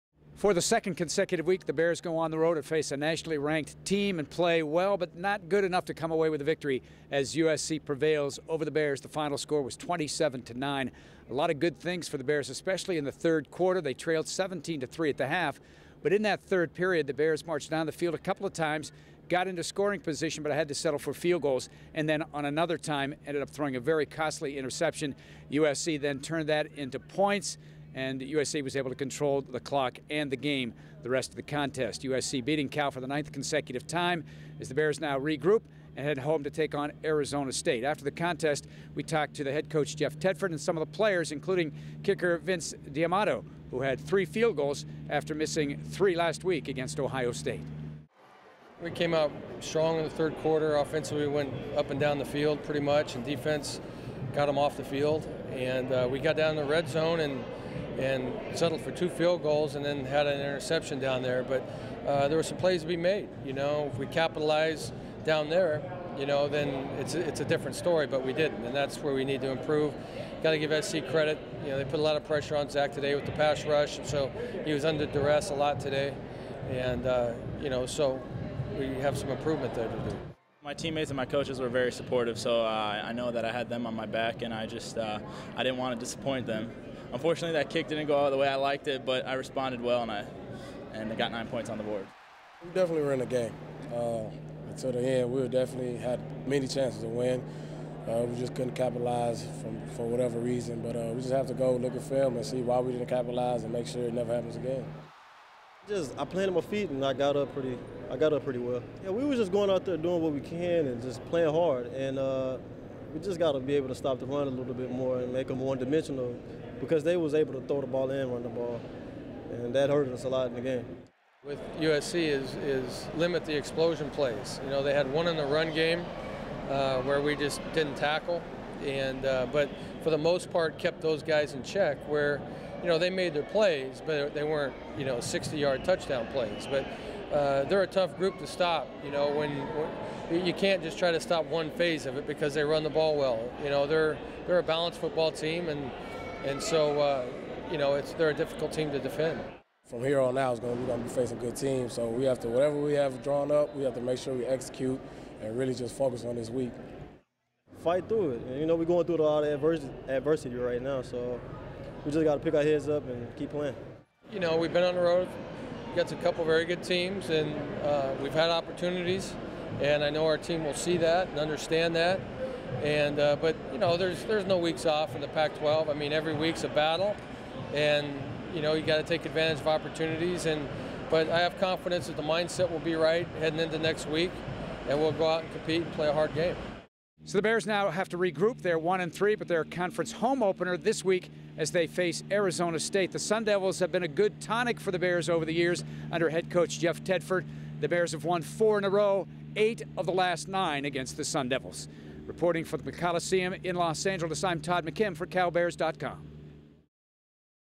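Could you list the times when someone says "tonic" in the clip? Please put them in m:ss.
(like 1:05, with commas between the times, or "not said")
3:14.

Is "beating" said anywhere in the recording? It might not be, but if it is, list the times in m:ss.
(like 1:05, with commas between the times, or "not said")
0:32.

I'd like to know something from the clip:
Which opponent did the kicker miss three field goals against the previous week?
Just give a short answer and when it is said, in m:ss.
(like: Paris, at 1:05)
Ohio State, at 0:46.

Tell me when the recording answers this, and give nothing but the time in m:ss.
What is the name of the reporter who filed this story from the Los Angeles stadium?
3:24.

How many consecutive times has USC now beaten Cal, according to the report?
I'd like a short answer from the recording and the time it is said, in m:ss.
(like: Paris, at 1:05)
ninth, at 0:33.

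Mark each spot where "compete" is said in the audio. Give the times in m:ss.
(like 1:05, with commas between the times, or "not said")
3:05.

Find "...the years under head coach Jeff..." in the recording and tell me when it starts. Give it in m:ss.
3:15.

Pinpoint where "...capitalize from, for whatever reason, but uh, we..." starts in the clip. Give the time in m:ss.
1:38.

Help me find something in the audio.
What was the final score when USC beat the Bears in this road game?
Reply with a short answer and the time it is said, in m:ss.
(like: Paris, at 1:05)
27 to 9, at 0:09.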